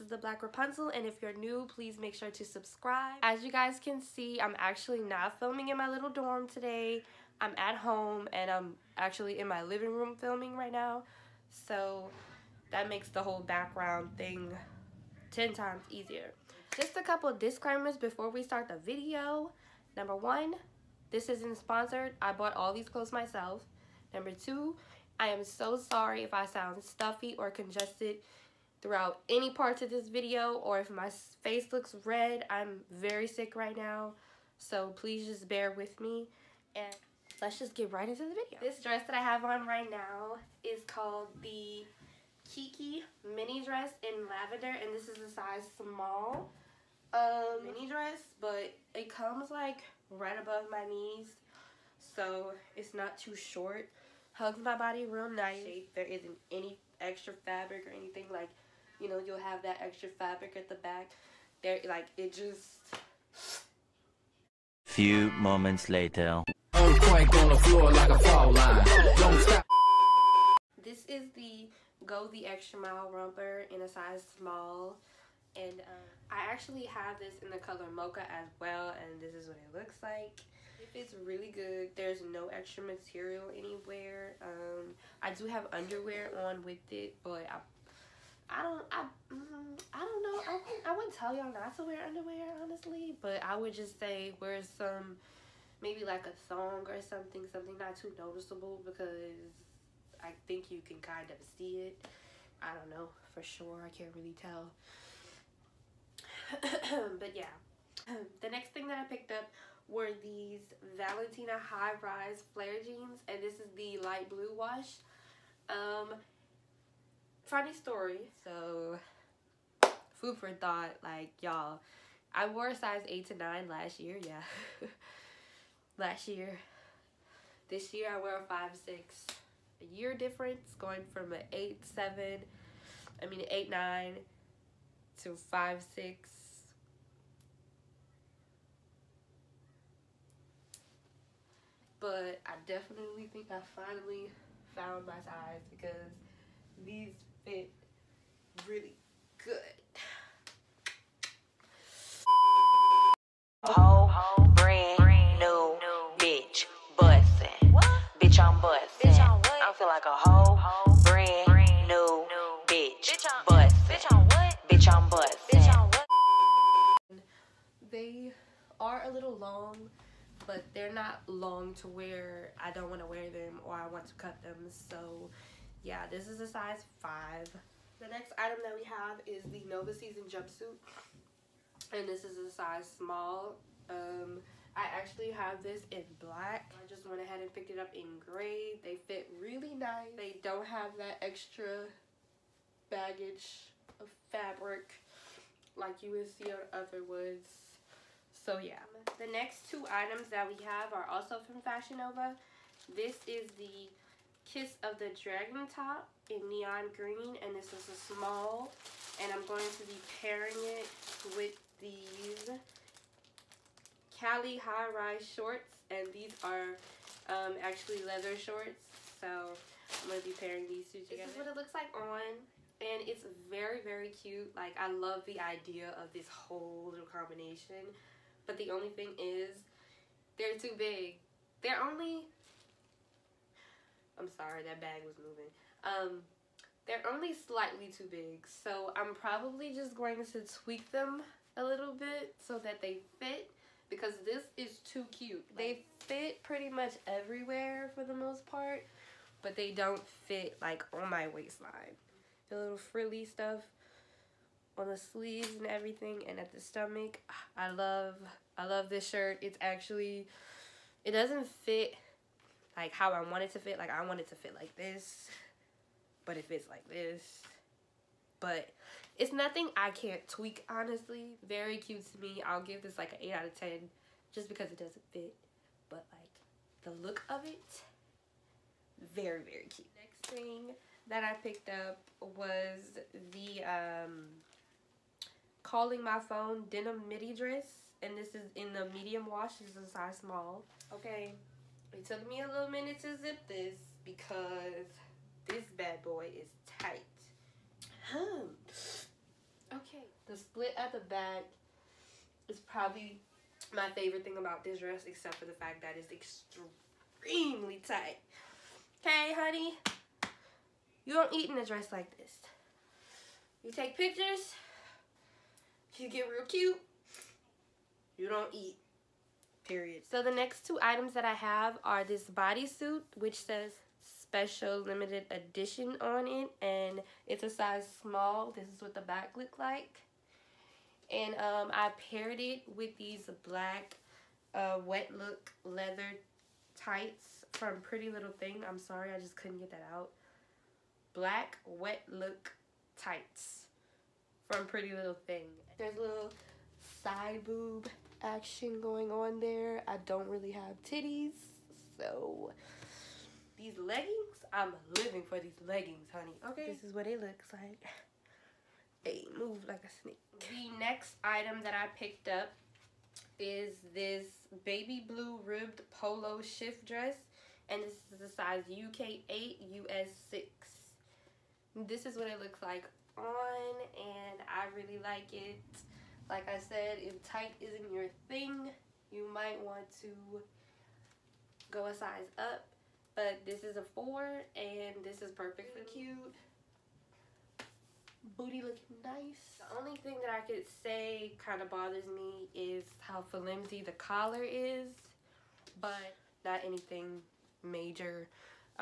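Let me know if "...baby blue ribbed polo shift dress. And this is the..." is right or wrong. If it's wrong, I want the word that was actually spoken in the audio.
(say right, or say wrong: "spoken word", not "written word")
right.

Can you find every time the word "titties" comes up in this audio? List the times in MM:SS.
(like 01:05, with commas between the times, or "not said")
05:50.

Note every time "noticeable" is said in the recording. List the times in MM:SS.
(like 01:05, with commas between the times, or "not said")
01:38.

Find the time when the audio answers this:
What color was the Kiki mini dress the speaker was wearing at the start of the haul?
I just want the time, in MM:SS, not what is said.
00:44.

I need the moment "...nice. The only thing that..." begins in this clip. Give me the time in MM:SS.
06:29.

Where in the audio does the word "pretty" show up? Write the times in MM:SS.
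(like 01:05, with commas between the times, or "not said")
04:06, 05:37, 05:44.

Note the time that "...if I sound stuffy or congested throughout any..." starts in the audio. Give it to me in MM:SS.
00:26.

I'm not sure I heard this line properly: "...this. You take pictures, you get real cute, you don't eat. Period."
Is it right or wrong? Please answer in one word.
right.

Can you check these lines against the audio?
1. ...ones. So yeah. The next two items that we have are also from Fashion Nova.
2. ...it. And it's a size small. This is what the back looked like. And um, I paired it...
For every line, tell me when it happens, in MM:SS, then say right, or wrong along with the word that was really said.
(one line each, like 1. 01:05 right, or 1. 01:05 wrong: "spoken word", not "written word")
1. 03:17 right
2. 05:26 right.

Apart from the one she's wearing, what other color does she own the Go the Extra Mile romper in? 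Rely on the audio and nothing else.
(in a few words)
Mocha.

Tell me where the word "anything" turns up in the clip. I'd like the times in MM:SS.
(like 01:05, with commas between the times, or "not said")
00:57, 06:36.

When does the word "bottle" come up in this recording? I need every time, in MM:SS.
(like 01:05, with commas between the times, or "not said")
not said.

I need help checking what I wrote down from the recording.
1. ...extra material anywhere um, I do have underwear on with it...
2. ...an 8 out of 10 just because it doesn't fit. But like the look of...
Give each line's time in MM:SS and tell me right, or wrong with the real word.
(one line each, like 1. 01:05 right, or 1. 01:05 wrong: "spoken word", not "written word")
1. 01:22 right
2. 04:33 right.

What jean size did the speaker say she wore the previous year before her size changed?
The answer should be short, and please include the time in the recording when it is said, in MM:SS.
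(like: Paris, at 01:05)
8 to 9, at 02:03.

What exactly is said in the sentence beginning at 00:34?
So please just bear with me and let's just get right into the video.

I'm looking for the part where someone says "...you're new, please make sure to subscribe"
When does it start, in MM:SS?
00:01.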